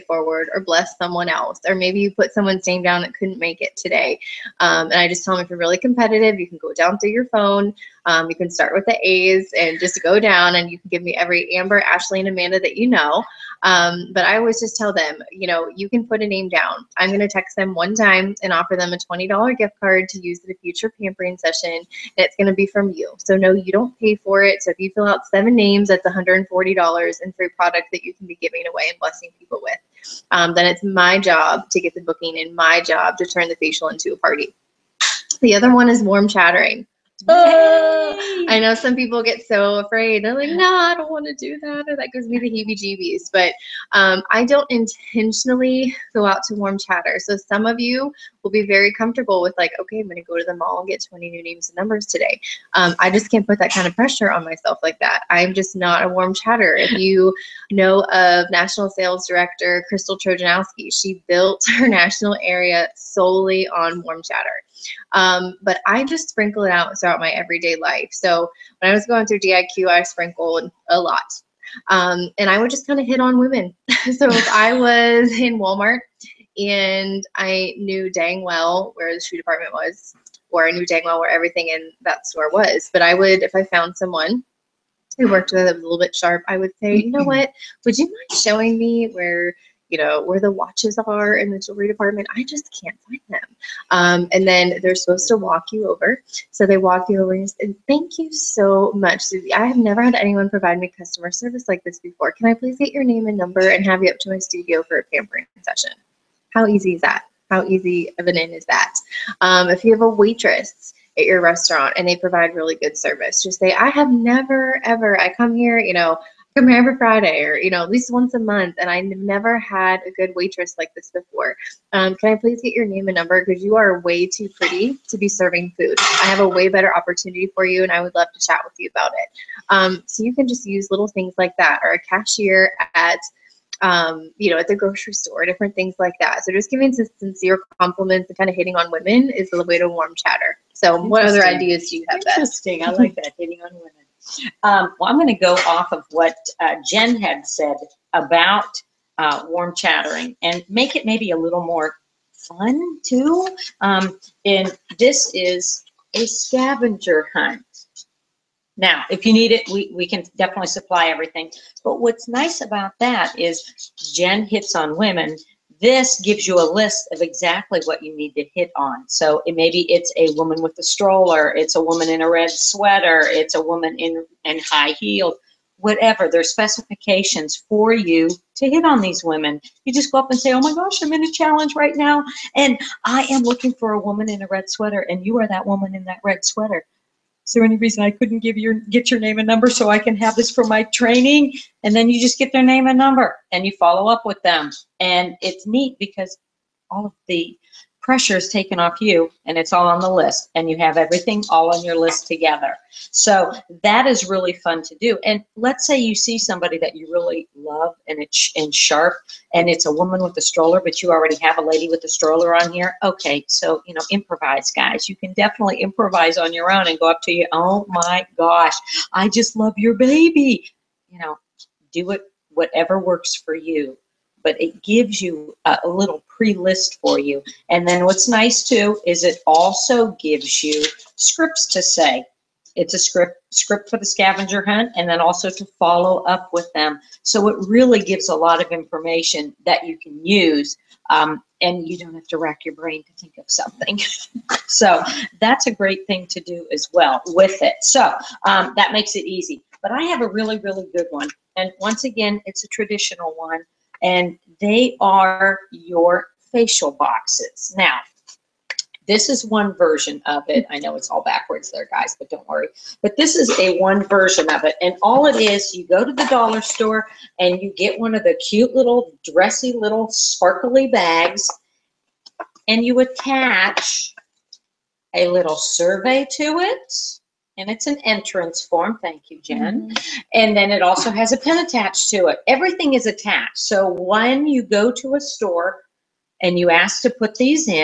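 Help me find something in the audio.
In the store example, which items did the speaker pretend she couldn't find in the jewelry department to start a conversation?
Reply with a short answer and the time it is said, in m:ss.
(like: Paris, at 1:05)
watches, at 1:30.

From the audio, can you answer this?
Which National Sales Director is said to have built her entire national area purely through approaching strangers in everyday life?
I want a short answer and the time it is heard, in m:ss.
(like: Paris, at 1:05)
Crystal Trojanowski, at 0:59.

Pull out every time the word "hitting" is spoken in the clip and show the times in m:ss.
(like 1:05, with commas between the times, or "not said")
2:18, 2:23.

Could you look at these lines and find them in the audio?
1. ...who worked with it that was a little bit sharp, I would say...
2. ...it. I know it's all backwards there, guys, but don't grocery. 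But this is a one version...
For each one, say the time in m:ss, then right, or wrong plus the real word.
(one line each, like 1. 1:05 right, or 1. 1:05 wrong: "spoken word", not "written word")
1. 1:25 right
2. 4:20 wrong: "worry", not "grocery".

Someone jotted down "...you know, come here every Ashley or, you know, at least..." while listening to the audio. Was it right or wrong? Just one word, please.
wrong.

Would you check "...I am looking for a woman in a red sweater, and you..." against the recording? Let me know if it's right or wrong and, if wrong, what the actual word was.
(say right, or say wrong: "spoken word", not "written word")
right.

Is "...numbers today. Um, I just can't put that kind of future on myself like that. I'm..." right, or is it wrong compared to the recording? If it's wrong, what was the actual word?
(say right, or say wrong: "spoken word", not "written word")
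wrong: "pressure", not "future".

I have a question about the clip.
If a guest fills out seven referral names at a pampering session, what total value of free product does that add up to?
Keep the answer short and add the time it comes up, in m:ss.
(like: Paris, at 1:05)
$140, at 0:26.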